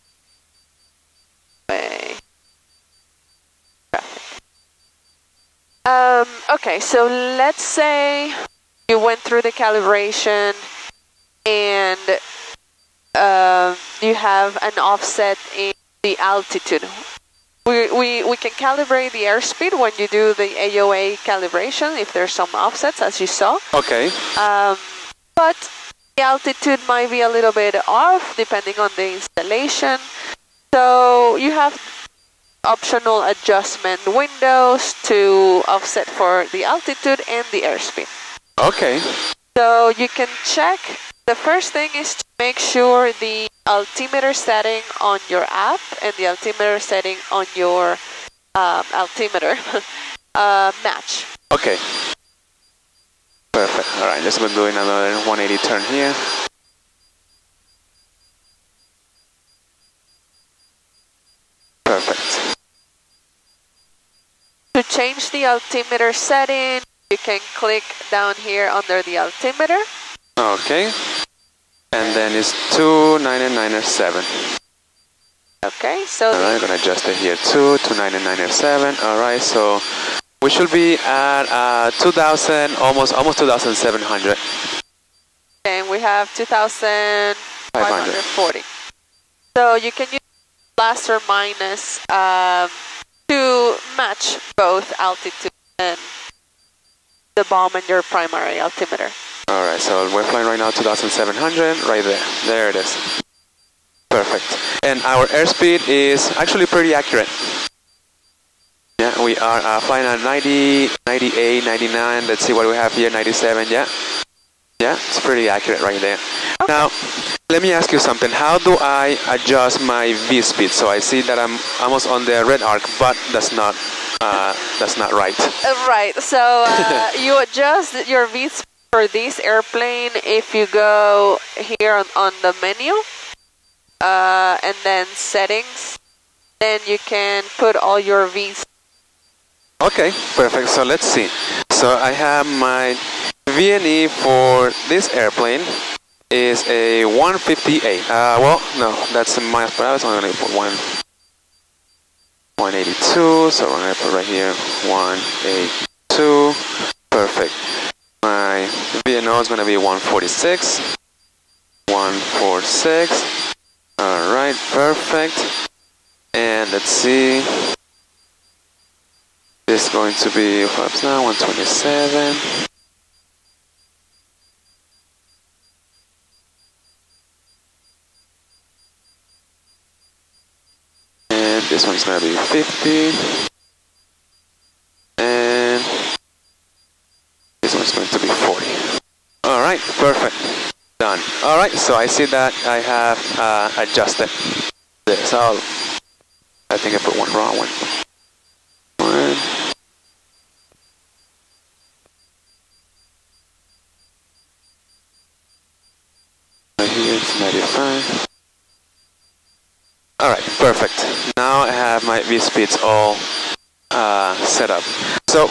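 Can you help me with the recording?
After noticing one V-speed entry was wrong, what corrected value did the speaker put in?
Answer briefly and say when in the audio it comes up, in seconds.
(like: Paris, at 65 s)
95, at 207 s.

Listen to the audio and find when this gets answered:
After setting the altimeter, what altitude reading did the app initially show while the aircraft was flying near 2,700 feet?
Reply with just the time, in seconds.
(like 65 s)
86 s.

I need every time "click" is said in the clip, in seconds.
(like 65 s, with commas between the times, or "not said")
67 s.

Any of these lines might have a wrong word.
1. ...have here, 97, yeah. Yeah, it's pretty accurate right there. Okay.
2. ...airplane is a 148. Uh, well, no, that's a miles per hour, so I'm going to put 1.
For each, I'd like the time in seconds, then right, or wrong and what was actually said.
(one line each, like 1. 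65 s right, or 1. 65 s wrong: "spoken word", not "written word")
1. 112 s right
2. 145 s wrong: "158", not "148".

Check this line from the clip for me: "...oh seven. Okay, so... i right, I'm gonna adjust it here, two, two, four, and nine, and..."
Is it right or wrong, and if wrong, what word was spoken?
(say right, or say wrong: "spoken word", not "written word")
wrong: "nine", not "four".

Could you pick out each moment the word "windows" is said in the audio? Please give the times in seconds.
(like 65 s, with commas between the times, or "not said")
34 s.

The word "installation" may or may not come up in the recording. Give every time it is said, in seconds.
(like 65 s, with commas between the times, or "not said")
29 s.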